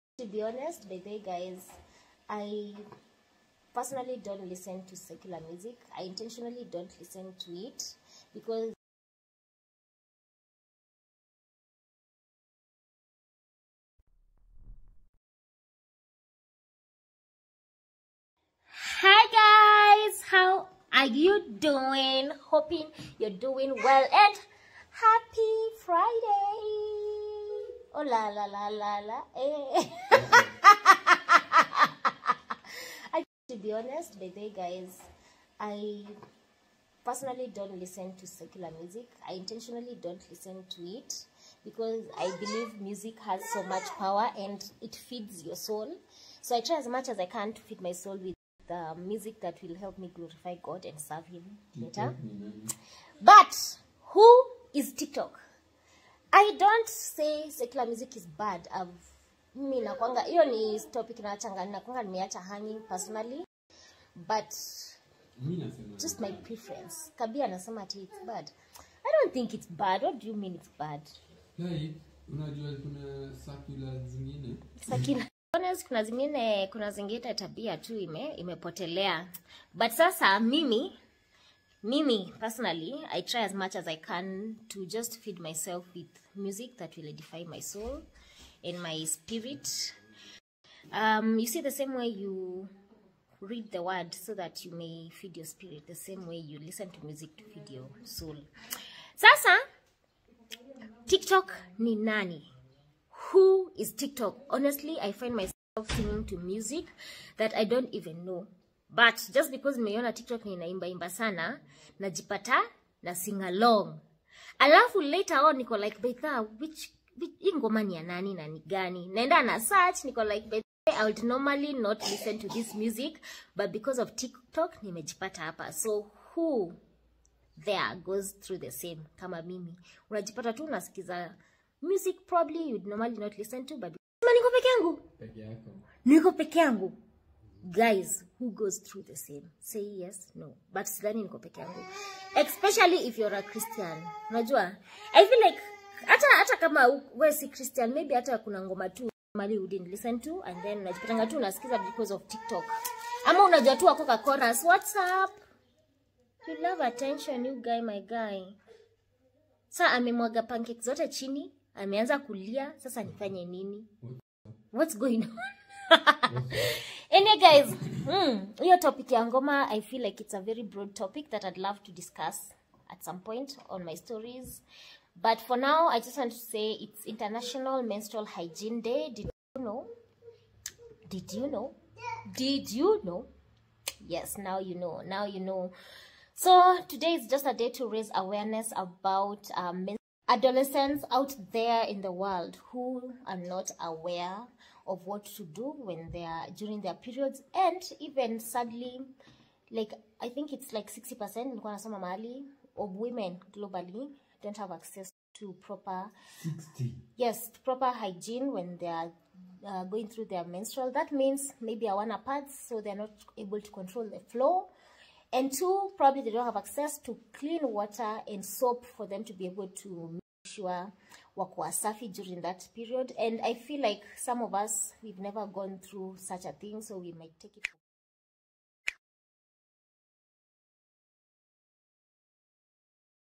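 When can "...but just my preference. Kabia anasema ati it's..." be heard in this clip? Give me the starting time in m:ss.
1:04.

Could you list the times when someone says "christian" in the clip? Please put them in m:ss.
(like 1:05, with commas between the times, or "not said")
2:23, 2:27.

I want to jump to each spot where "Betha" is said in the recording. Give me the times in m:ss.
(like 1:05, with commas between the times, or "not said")
1:56, 2:00.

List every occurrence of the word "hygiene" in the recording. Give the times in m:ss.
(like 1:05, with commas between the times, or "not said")
2:58, 3:27.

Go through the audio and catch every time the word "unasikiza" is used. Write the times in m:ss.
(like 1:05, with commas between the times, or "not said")
2:10, 2:31.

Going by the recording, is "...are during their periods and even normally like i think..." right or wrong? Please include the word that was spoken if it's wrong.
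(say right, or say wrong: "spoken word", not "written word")
wrong: "sadly", not "normally".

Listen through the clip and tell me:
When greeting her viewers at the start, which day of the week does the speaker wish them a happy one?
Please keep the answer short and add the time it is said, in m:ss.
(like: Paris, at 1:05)
Friday, at 0:25.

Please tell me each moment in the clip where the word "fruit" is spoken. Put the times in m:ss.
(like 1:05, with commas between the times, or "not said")
not said.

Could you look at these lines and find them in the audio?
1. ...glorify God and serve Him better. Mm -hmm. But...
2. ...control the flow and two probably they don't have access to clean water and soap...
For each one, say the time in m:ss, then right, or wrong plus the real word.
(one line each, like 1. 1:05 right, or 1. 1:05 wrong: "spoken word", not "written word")
1. 0:50 right
2. 3:33 right.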